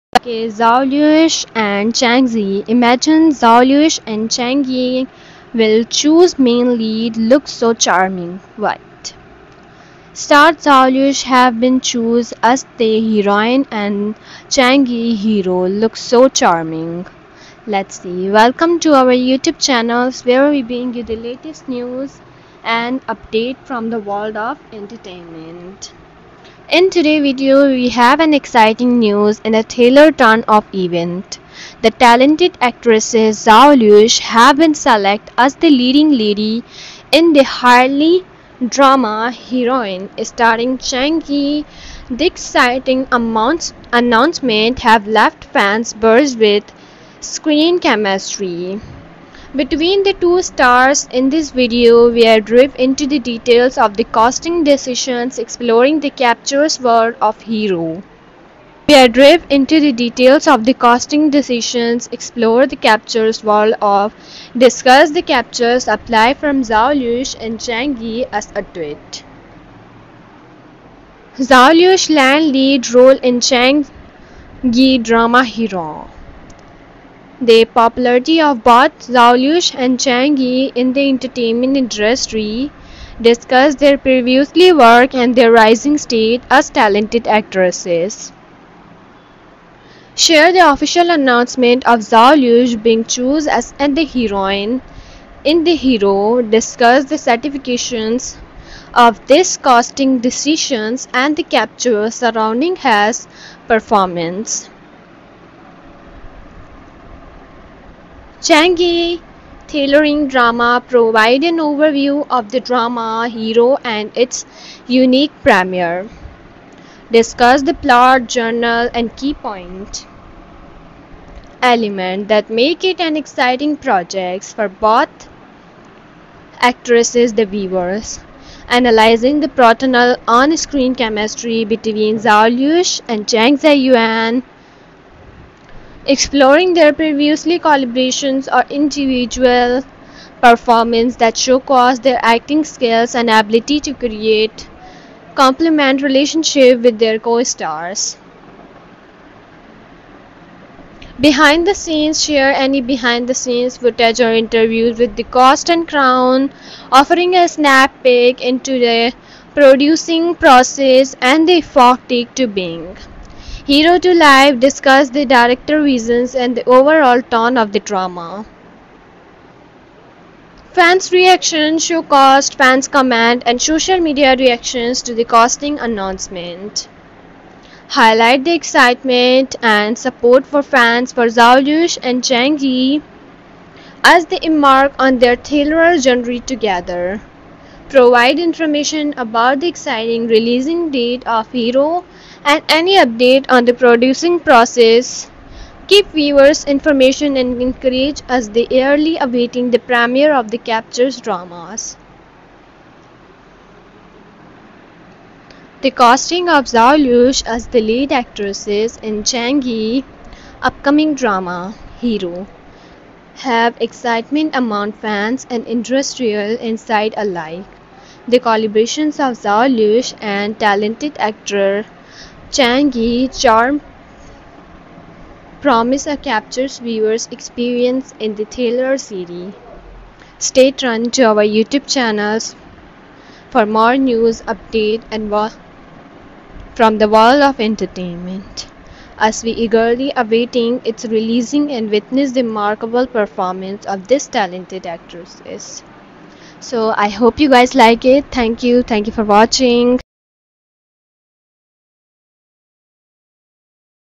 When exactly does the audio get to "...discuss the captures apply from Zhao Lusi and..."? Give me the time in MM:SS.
01:04.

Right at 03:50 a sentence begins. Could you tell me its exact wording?
Stay tuned to our YouTube channels for more news update and from the world of entertainment.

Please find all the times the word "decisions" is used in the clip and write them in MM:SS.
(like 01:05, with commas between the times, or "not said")
00:54, 01:01, 01:40.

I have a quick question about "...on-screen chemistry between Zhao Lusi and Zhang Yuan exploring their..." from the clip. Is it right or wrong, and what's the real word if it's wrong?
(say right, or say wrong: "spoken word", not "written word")
right.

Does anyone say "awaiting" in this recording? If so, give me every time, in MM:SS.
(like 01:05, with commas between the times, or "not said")
03:19, 04:00.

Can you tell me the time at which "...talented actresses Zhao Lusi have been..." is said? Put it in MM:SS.
00:31.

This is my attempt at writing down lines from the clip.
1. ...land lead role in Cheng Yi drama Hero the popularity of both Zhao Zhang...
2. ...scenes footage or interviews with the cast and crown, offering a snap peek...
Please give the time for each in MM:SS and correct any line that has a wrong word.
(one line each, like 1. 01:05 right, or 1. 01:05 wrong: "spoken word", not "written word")
1. 01:12 wrong: "Lusi", not "Zhang"
2. 02:33 right.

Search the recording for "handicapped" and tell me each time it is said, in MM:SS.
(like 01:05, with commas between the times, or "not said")
not said.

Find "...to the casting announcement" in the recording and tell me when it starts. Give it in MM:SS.
02:55.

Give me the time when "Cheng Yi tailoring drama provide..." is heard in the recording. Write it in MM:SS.
01:48.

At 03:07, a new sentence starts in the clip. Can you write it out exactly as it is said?
Provide information about the exciting releasing date of Hero and any update on the producing process.